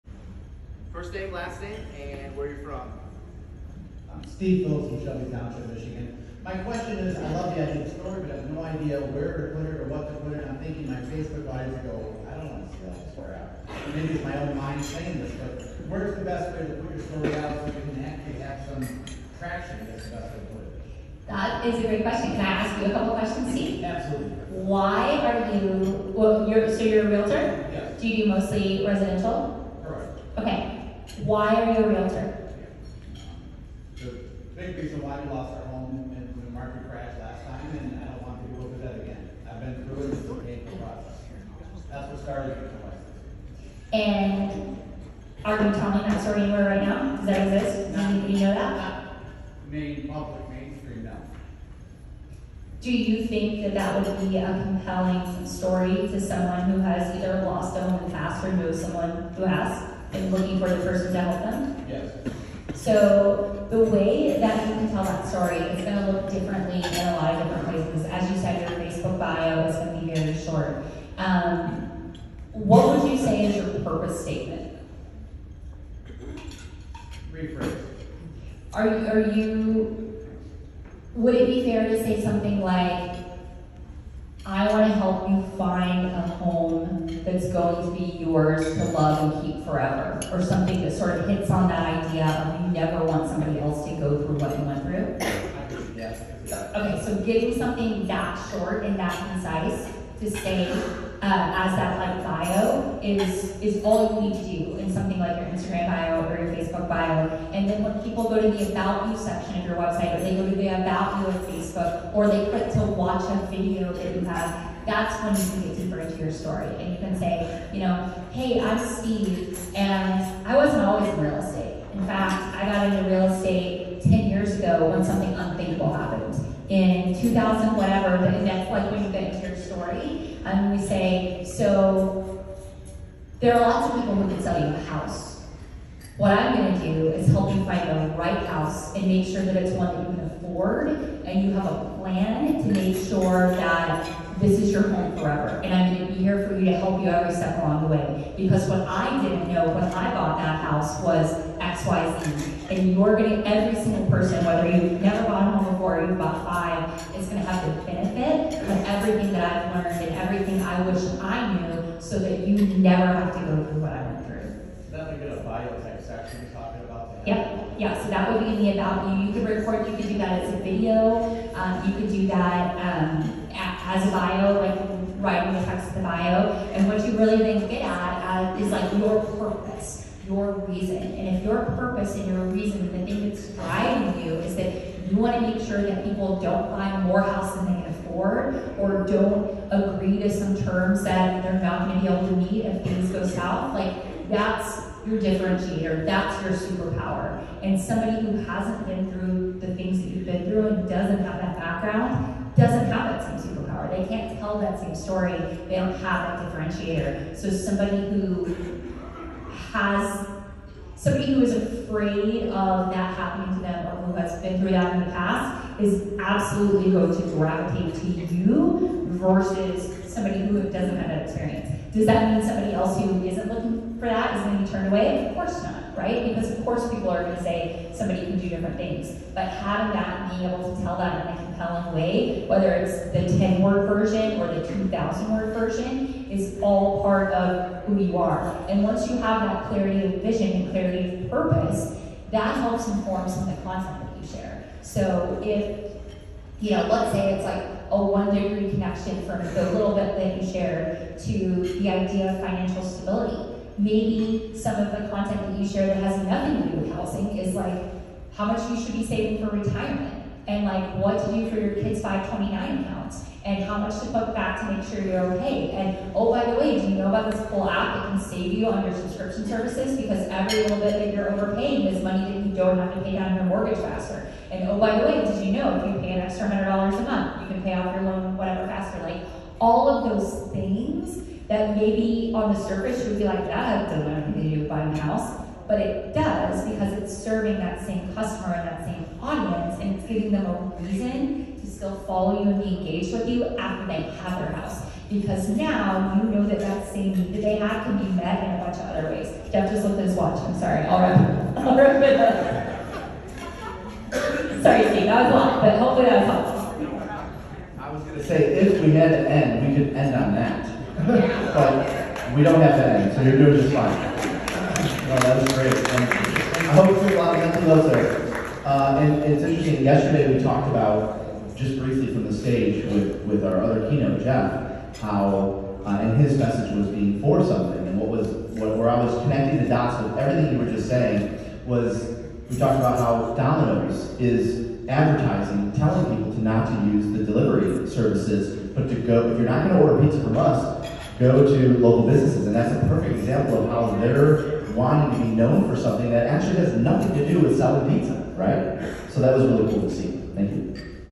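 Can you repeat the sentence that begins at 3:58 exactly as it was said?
And once you have that clarity of vision and clarity of purpose, that helps inform some of the content that you share.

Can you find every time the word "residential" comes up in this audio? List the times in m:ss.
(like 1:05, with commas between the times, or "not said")
0:28.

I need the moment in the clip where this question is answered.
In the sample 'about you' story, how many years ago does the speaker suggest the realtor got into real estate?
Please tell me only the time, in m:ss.
2:04.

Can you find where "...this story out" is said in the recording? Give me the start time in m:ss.
0:12.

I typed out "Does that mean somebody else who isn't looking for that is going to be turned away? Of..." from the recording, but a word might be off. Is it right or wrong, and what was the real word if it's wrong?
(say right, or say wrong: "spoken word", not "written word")
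right.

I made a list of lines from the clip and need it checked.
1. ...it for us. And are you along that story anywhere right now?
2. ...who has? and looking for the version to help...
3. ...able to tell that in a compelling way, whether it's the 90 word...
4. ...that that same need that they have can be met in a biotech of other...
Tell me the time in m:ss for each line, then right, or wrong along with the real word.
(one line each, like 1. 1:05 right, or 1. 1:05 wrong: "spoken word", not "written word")
1. 0:42 wrong: "telling", not "along"
2. 0:59 wrong: "person", not "version"
3. 3:50 wrong: "10", not "90"
4. 4:56 wrong: "bunch", not "biotech".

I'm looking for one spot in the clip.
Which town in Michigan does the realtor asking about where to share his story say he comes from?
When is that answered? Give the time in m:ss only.
0:05.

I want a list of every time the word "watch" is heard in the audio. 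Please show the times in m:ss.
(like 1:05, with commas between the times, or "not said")
1:52, 5:00.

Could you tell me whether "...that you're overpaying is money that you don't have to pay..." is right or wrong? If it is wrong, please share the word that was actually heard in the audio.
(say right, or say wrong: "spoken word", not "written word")
right.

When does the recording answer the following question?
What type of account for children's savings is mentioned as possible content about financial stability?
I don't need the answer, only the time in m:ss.
4:22.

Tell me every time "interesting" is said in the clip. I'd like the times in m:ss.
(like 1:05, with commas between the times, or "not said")
5:19.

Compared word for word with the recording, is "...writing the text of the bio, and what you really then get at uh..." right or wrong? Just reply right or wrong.
right.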